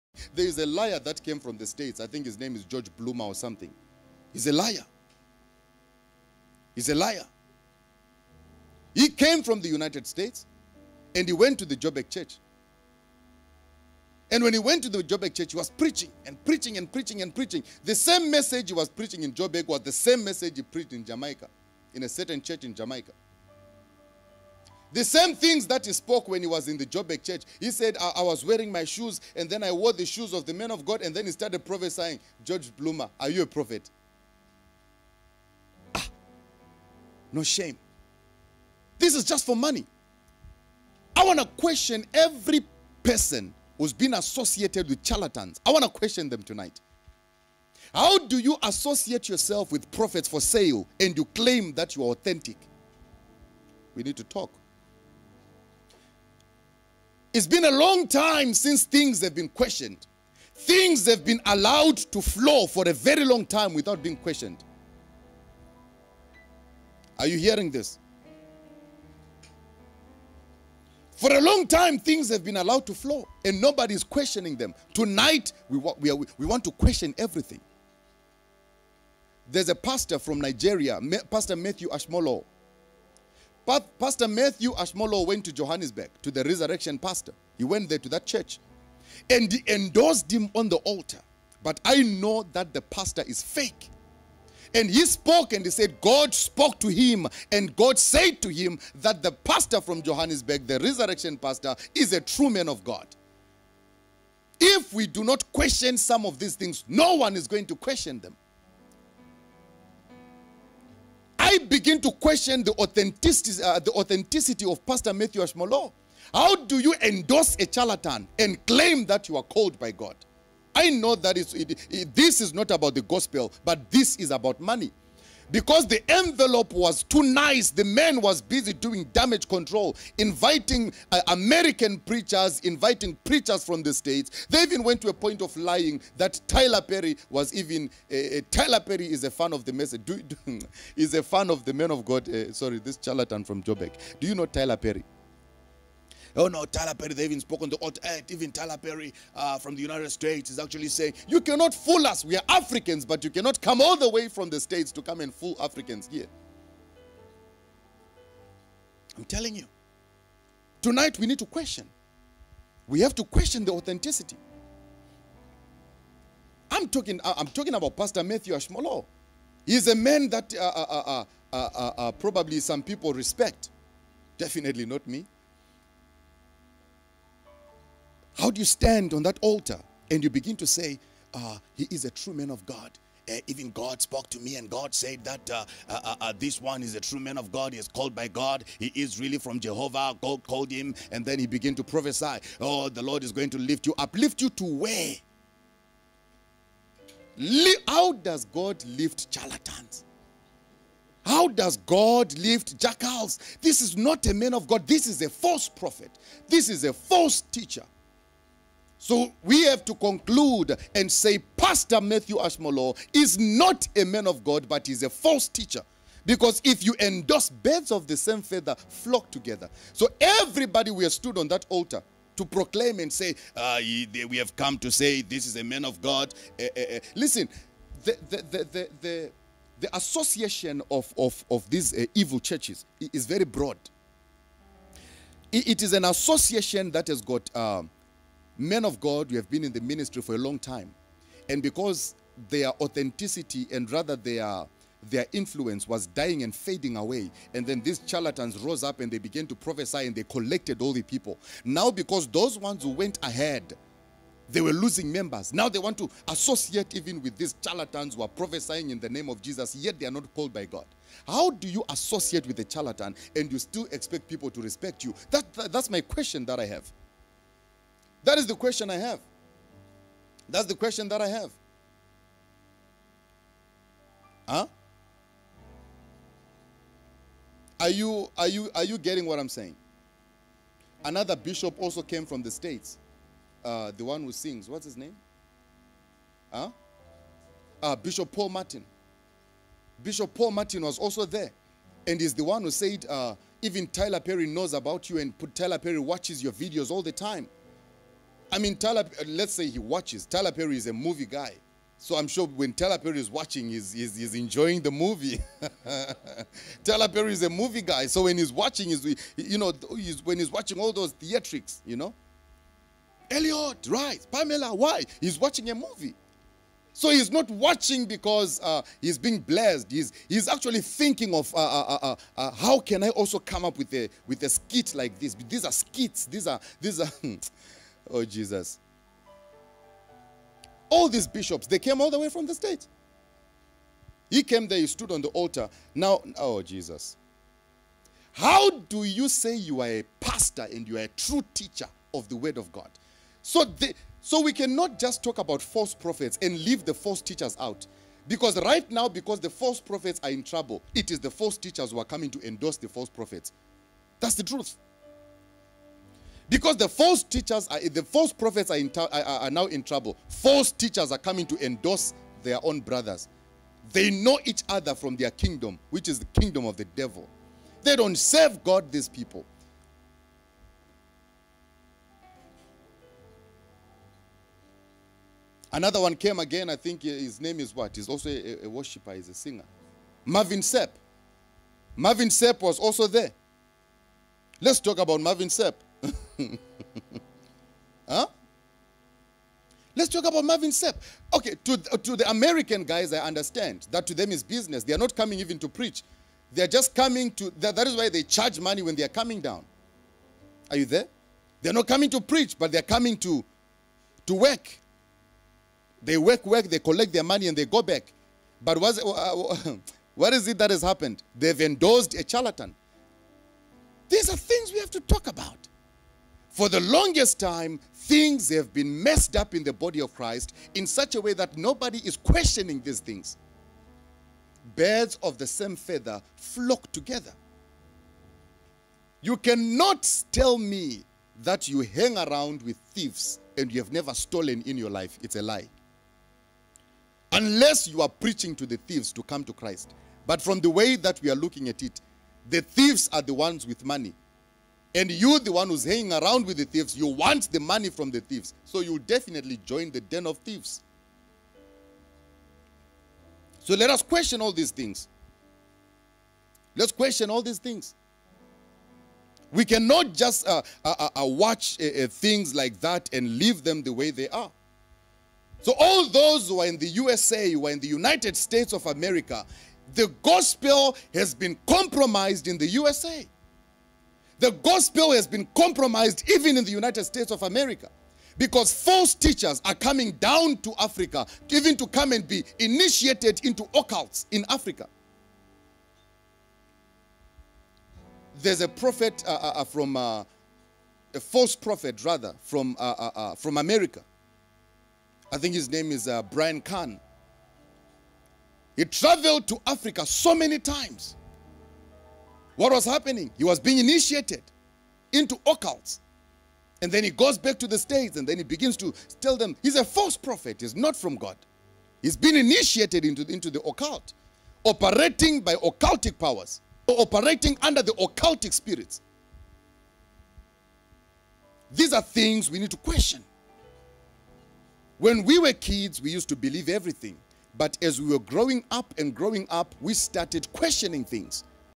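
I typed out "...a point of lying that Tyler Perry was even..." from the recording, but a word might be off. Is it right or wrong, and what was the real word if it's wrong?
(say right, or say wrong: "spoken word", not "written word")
right.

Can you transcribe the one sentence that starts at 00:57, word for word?
It's been a long time since things have been questioned.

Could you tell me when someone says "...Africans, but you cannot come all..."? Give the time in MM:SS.
02:32.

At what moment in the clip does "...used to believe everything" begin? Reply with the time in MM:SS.
08:46.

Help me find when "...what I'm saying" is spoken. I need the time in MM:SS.
04:39.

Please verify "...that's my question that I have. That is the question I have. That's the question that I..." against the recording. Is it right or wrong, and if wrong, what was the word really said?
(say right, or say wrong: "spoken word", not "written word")
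right.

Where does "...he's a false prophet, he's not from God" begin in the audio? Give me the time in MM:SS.
08:29.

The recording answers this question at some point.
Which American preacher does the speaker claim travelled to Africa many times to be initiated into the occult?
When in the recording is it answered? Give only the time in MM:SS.
08:16.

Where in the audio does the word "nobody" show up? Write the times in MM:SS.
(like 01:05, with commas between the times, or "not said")
01:13, 07:01.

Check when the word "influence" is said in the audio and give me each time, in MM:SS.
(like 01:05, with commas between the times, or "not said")
04:05.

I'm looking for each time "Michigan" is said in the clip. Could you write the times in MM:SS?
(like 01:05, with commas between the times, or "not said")
not said.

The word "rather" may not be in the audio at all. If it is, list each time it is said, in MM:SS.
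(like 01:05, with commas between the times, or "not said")
04:03, 08:12.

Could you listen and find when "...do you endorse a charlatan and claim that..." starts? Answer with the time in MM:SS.
01:56.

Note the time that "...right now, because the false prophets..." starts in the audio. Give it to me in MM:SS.
05:48.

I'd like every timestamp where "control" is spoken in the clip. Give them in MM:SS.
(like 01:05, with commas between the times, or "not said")
02:09.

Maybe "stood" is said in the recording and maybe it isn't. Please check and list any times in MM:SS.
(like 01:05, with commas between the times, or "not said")
03:41, 05:34.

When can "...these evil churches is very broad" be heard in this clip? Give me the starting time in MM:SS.
03:51.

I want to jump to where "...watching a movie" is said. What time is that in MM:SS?
05:15.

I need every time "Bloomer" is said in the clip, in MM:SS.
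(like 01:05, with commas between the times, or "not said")
00:02, 00:32.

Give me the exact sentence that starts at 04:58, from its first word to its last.
I mean, Tyler, uh, let's say he watches.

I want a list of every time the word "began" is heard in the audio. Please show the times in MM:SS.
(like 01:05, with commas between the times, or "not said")
03:11, 04:09.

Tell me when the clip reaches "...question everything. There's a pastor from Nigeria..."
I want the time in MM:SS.
01:16.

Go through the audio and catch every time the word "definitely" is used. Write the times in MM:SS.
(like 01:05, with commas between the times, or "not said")
02:54, 07:28.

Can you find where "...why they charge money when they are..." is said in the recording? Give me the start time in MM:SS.
06:37.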